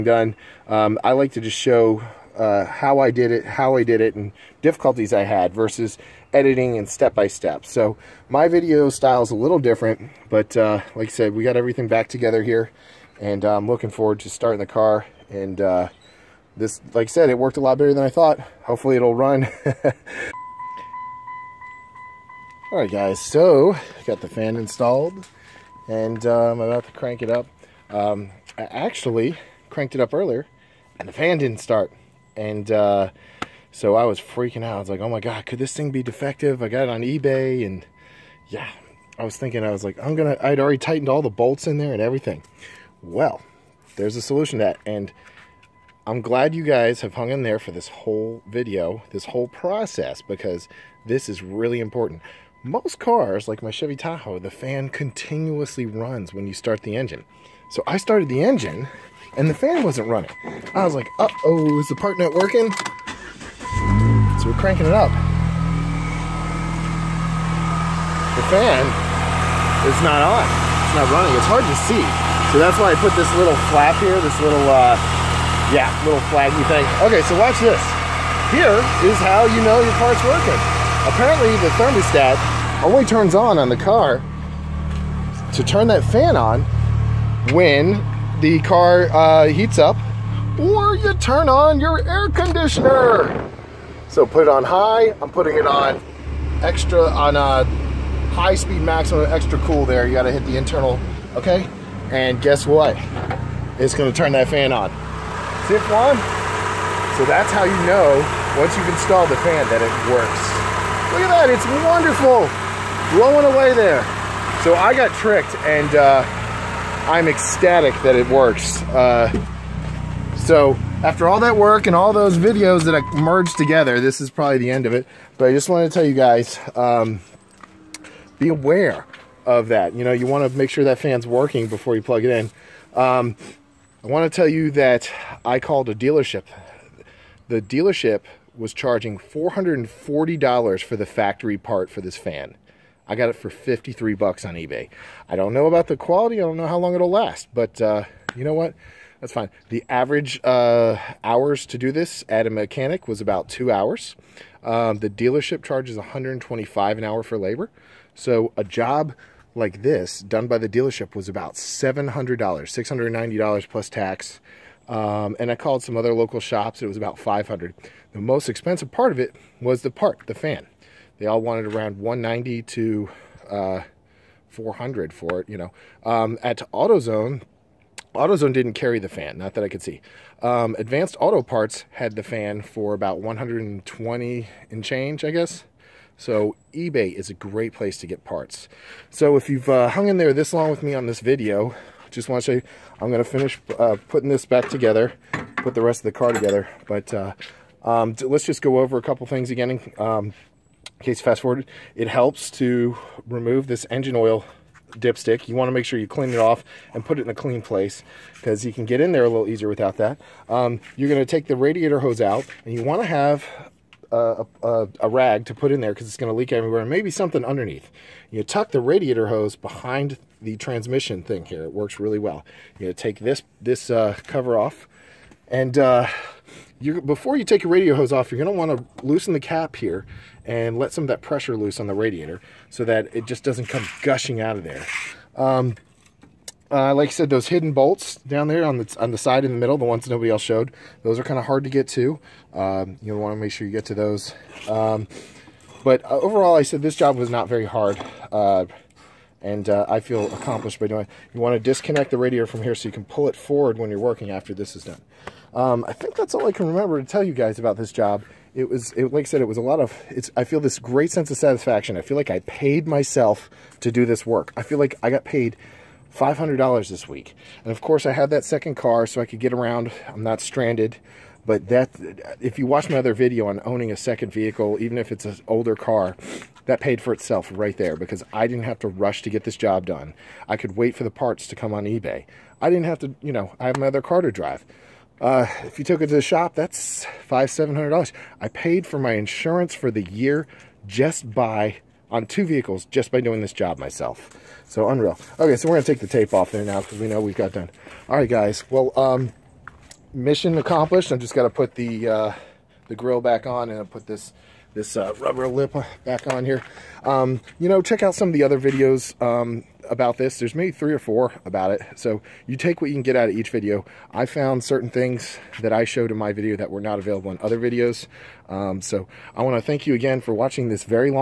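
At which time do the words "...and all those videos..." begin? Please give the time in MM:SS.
02:01.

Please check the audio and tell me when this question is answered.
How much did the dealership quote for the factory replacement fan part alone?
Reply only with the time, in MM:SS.
02:19.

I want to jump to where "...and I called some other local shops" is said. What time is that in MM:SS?
02:45.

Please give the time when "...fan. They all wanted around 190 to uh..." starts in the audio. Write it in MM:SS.
02:50.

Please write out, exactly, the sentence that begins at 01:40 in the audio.
You got to hit the internal, okay?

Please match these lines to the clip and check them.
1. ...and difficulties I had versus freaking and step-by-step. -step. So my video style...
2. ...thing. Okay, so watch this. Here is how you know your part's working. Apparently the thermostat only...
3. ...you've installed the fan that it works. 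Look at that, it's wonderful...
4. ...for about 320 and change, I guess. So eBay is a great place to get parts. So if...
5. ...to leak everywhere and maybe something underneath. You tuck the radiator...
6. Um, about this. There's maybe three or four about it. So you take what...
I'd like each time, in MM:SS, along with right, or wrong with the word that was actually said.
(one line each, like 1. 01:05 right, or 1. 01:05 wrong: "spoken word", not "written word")
1. 00:04 wrong: "editing", not "freaking"
2. 01:16 right
3. 01:48 right
4. 03:02 wrong: "120", not "320"
5. 03:36 right
6. 05:09 right.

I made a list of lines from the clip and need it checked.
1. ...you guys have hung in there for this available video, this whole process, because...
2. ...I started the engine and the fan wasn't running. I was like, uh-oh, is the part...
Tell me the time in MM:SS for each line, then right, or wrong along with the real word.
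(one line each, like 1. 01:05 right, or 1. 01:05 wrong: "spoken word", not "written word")
1. 00:46 wrong: "whole", not "available"
2. 00:57 right.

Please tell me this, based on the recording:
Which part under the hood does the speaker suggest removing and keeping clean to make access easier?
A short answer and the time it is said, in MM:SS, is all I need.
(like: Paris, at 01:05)
engine oil dipstick, at 03:23.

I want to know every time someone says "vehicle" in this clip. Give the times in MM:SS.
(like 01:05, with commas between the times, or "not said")
04:34, 04:52.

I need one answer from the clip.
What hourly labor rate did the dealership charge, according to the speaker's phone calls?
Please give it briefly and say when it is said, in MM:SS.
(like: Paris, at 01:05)
$125, at 02:35.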